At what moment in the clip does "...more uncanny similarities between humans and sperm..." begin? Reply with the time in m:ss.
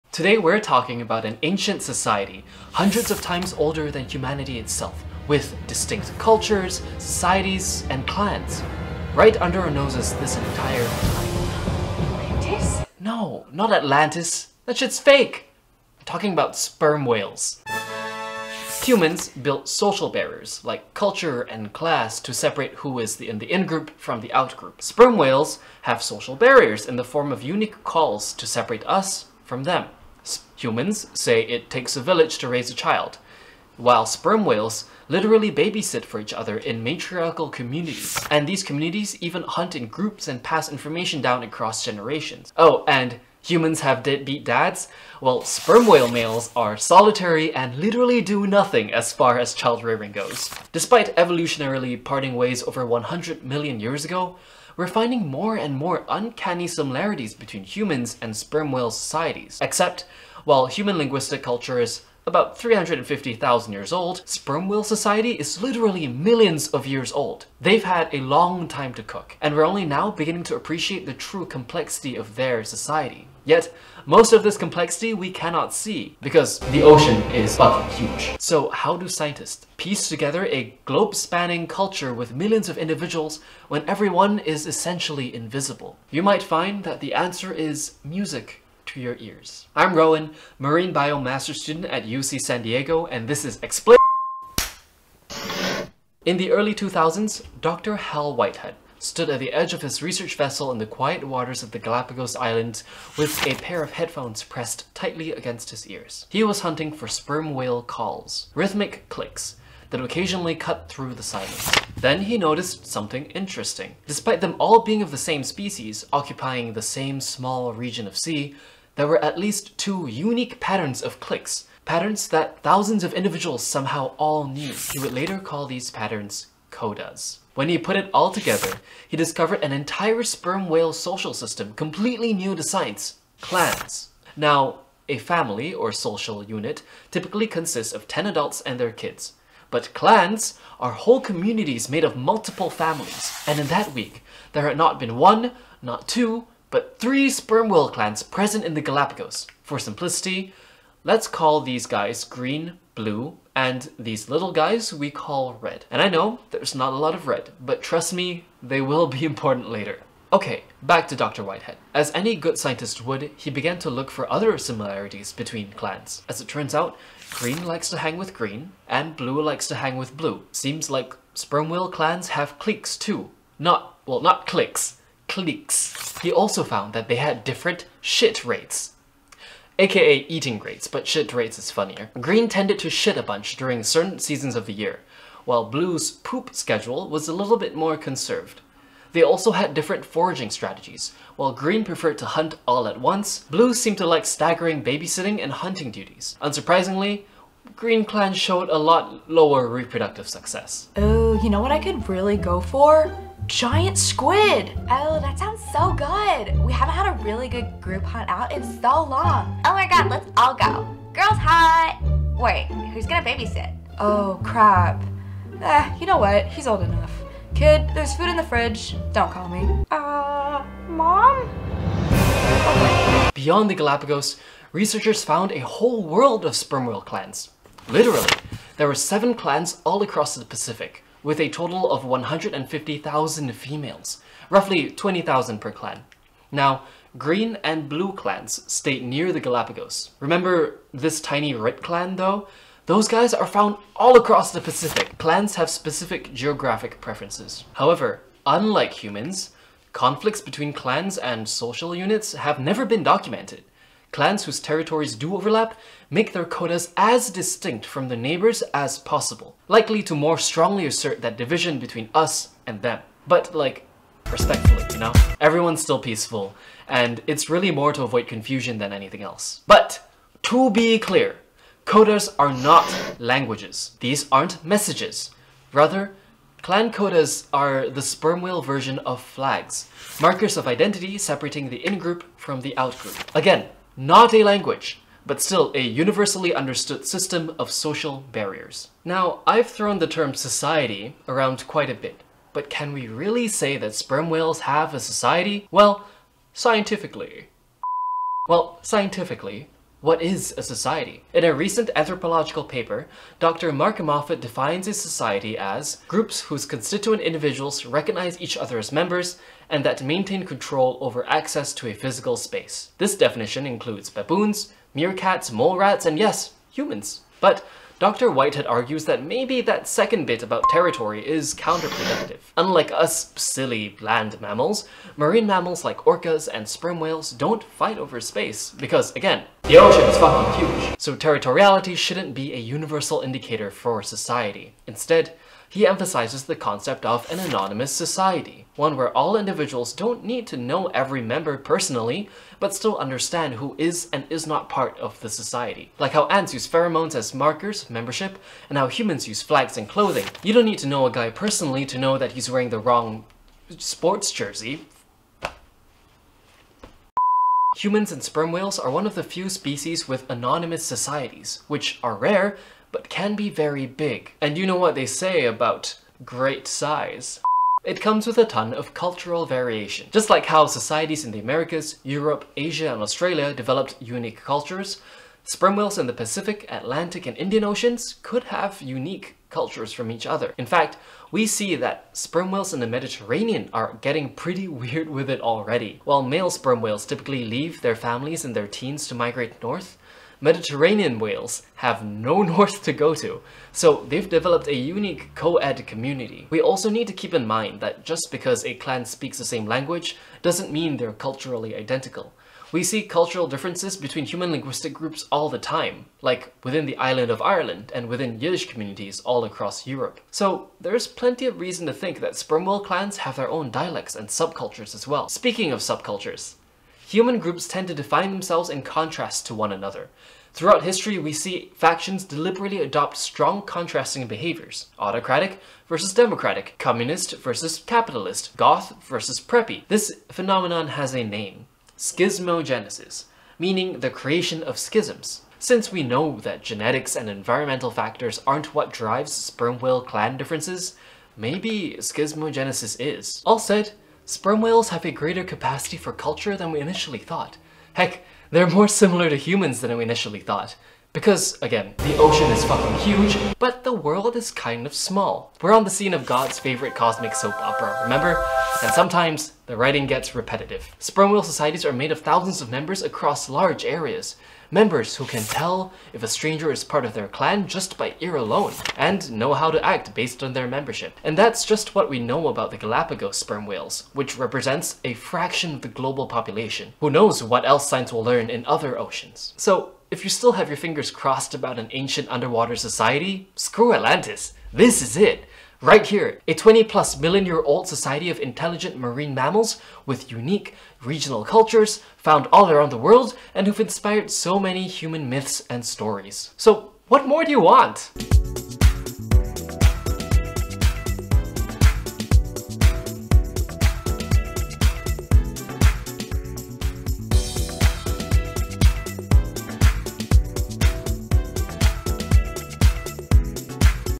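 0:55.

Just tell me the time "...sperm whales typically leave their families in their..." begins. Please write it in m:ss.
6:26.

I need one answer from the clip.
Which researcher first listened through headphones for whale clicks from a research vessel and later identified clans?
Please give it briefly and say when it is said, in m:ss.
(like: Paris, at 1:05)
Dr. Hal Whitehead, at 1:37.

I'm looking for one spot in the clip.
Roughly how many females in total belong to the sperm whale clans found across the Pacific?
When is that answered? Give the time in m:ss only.
3:52.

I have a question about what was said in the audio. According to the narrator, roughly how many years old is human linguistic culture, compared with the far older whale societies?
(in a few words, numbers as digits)
350,000 years.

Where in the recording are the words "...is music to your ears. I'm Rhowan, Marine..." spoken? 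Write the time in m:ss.
1:27.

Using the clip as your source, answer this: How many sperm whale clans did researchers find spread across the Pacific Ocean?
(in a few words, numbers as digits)
7.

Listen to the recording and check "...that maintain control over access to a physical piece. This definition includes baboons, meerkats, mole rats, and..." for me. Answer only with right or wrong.
wrong.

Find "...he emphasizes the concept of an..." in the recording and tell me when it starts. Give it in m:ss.
5:35.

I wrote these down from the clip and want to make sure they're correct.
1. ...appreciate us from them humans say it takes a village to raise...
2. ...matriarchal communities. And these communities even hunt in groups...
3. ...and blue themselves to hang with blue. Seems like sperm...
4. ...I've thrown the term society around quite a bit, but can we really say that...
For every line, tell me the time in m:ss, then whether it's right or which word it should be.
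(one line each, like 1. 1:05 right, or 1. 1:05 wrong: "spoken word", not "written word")
1. 0:28 wrong: "separate", not "appreciate"
2. 0:36 right
3. 2:48 wrong: "likes", not "themselves"
4. 4:49 right.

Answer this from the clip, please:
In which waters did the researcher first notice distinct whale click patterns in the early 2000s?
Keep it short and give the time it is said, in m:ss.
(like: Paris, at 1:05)
Galapagos Islands, at 1:41.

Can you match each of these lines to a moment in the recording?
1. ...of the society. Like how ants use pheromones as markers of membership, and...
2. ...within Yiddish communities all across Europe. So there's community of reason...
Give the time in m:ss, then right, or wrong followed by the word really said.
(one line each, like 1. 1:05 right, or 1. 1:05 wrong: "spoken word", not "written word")
1. 5:44 right
2. 6:48 wrong: "plenty", not "community".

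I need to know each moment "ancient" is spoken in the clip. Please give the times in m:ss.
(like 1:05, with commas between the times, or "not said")
0:01, 8:01.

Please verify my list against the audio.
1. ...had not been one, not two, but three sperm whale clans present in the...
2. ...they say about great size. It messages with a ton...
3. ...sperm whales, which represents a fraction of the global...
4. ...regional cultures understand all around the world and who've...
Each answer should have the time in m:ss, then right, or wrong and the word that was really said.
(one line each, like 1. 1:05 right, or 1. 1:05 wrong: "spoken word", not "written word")
1. 2:24 right
2. 6:04 wrong: "comes", not "messages"
3. 7:53 right
4. 8:11 wrong: "found", not "understand".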